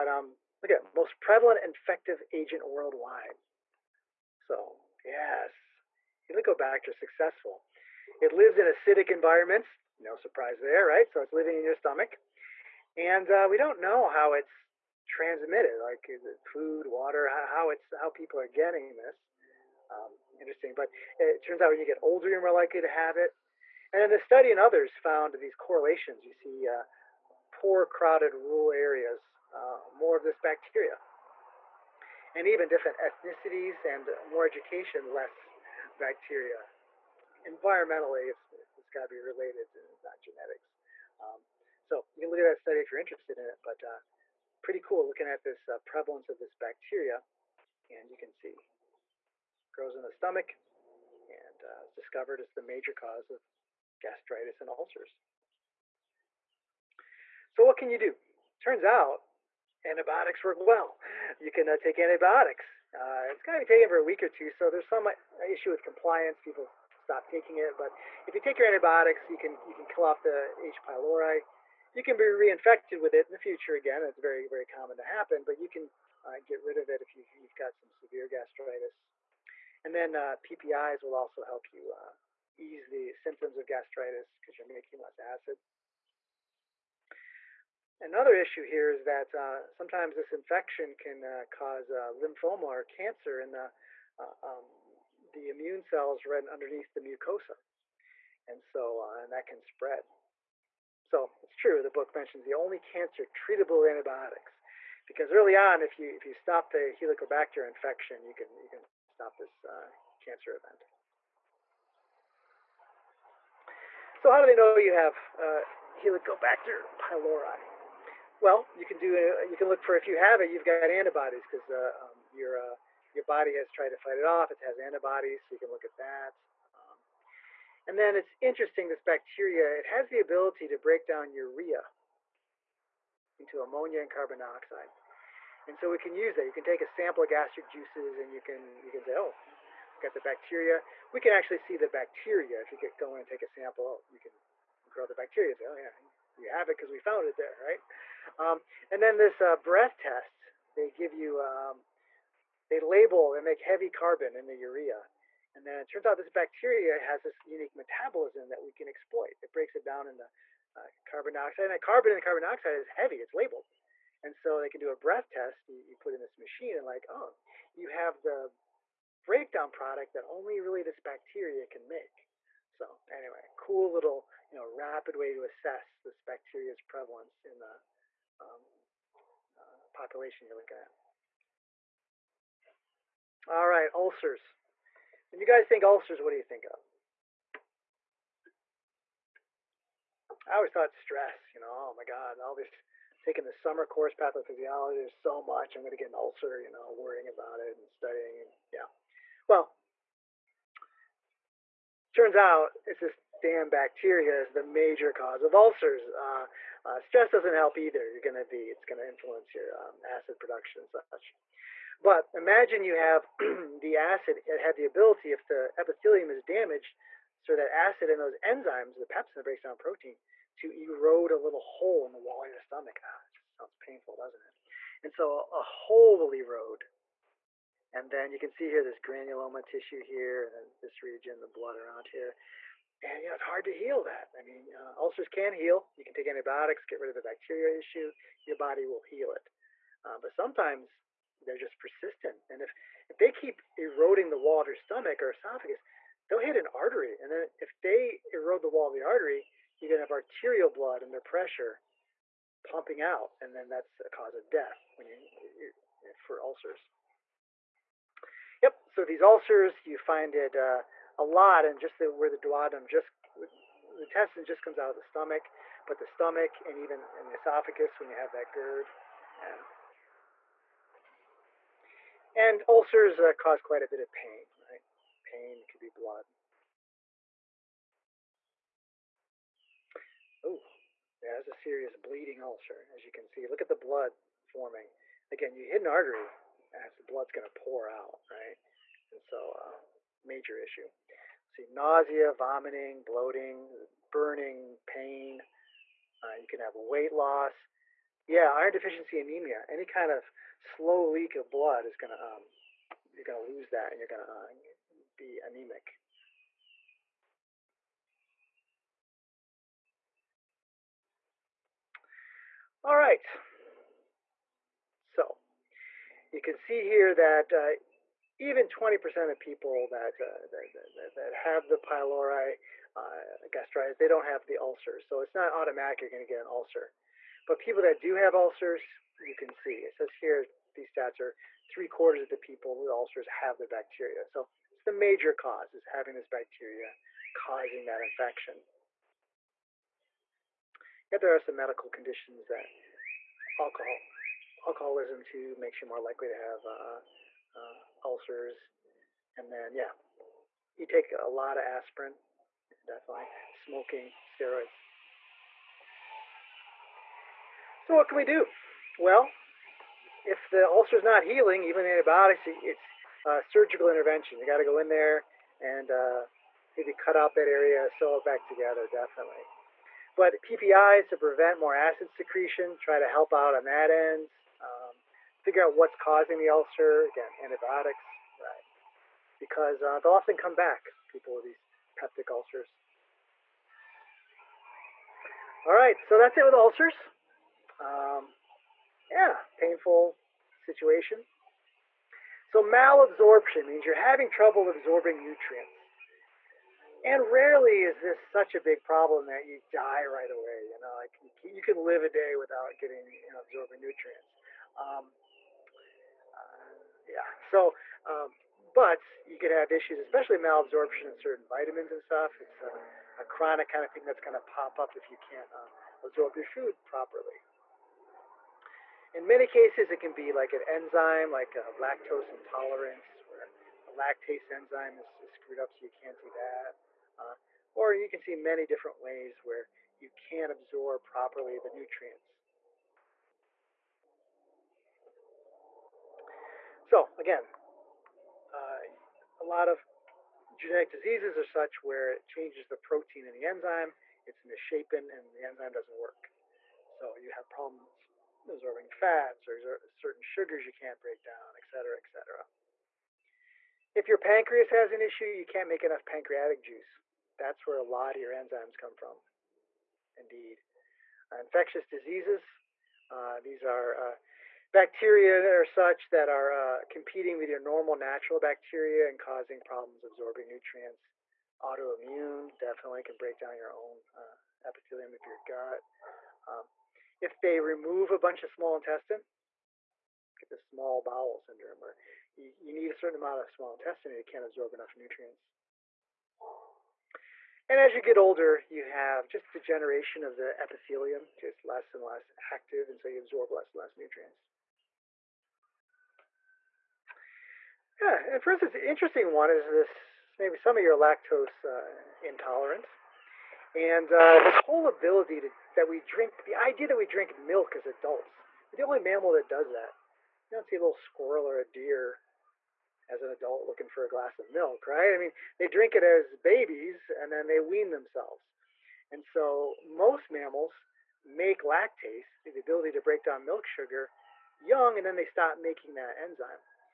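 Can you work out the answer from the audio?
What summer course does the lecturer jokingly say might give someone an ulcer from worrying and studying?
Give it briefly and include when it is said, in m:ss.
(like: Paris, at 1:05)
pathophysiology, at 3:14.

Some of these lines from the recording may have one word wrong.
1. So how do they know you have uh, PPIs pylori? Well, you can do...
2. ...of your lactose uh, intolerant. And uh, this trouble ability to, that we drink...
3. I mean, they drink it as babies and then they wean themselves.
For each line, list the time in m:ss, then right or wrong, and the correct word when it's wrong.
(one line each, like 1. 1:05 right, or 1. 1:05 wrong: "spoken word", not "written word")
1. 1:54 wrong: "Helicobacter", not "PPIs"
2. 8:20 wrong: "whole", not "trouble"
3. 8:35 right.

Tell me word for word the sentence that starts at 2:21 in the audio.
We can actually see the bacteria if you get going and take a sample.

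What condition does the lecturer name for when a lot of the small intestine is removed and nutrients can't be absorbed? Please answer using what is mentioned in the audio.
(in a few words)
small bowel syndrome.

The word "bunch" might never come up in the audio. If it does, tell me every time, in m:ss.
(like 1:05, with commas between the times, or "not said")
7:58.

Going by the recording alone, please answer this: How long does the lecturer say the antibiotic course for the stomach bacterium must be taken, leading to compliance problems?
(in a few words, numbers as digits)
a week or two.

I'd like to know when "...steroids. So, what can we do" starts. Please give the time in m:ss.
5:54.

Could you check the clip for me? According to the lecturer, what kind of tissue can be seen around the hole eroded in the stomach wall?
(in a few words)
granuloma tissue.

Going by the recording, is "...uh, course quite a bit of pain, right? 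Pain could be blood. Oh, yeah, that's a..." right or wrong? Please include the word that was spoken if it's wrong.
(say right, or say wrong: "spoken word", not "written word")
wrong: "cause", not "course".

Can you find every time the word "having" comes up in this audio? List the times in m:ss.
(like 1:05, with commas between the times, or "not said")
5:35, 6:33.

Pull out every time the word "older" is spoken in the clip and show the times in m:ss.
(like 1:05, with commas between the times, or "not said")
0:22, 8:08.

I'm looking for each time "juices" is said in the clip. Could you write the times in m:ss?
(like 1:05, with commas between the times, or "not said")
2:17, 7:36.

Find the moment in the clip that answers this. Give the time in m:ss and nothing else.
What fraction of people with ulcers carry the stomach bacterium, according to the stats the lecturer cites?
5:31.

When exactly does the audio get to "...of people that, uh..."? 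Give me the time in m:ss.
5:19.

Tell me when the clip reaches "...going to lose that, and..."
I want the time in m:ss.
5:03.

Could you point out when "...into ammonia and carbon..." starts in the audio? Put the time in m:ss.
2:13.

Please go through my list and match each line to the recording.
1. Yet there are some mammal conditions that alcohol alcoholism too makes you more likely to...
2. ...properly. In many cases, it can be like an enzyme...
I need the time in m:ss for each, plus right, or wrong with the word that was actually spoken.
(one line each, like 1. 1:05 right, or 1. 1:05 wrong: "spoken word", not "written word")
1. 5:41 wrong: "medical", not "mammal"
2. 6:56 right.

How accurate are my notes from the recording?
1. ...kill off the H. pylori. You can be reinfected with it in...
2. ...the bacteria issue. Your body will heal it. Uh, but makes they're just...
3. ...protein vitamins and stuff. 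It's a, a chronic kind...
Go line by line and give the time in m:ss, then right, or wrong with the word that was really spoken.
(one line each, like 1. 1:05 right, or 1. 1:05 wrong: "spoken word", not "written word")
1. 1:09 right
2. 3:57 wrong: "sometimes", not "makes"
3. 6:51 wrong: "certain", not "protein".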